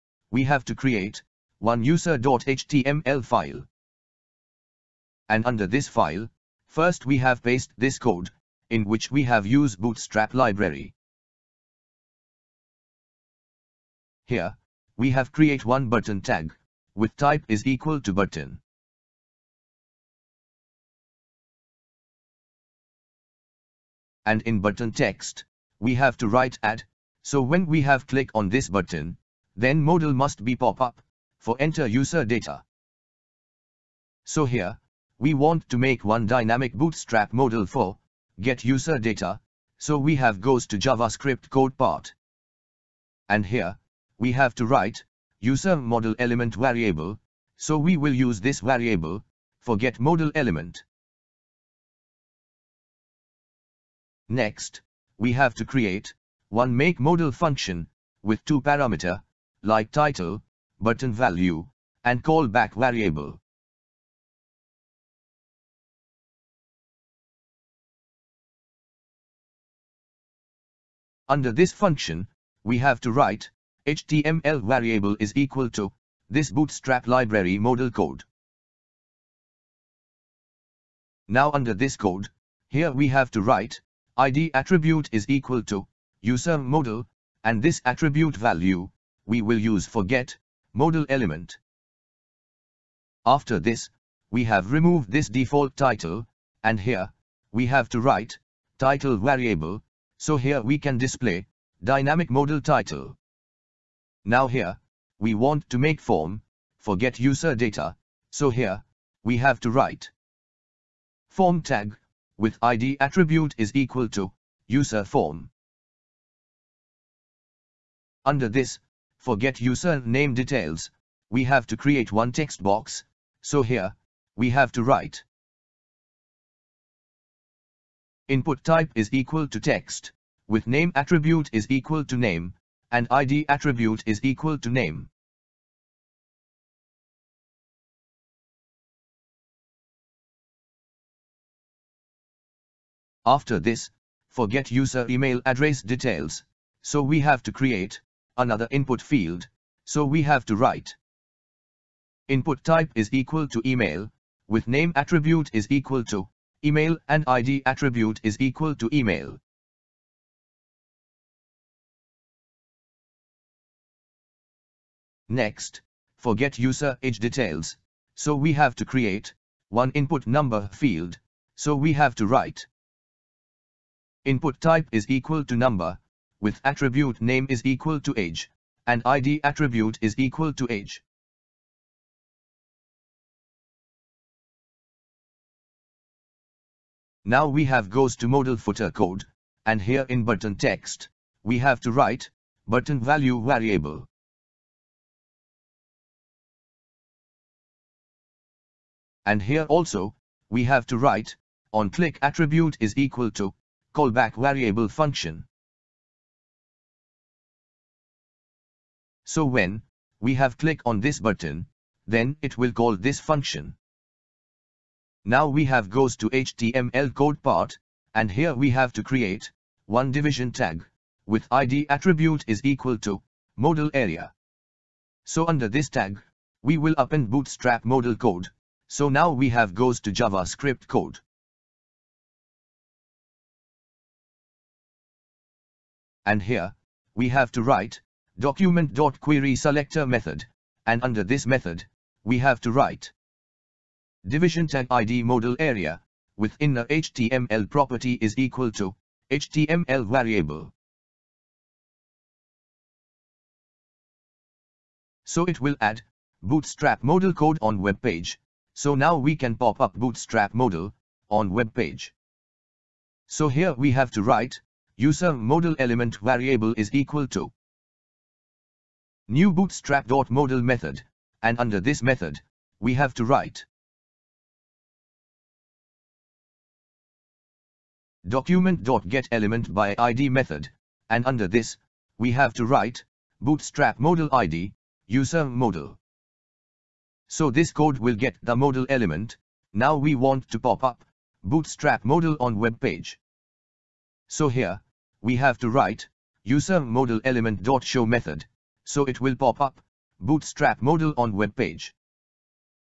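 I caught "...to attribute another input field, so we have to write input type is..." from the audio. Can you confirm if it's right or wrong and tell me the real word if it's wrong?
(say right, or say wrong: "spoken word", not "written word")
wrong: "create", not "attribute".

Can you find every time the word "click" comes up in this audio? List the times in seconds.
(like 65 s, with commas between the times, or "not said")
28 s, 201 s, 210 s.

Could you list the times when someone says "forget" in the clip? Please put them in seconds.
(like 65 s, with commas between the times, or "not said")
106 s, 119 s, 144 s, 166 s.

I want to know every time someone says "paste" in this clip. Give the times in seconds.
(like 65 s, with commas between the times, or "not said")
7 s.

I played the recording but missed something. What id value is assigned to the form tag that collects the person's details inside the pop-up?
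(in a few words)
user form.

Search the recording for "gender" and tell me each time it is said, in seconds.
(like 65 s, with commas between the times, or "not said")
not said.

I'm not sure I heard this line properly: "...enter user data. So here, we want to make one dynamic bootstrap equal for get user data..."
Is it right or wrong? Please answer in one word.
wrong.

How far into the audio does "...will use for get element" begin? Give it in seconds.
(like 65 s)
89 s.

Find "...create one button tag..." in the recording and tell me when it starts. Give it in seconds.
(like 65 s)
15 s.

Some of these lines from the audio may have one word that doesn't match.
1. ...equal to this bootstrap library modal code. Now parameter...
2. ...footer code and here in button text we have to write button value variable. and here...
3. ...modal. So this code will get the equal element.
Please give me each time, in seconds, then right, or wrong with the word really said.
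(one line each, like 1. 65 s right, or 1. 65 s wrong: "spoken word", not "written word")
1. 75 s wrong: "under", not "parameter"
2. 188 s right
3. 285 s wrong: "modal", not "equal".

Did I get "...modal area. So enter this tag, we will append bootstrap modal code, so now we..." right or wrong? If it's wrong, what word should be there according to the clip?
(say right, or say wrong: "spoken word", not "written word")
wrong: "under", not "enter".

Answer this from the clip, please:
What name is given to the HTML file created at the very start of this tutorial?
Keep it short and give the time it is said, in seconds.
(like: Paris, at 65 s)
user.html, at 1 s.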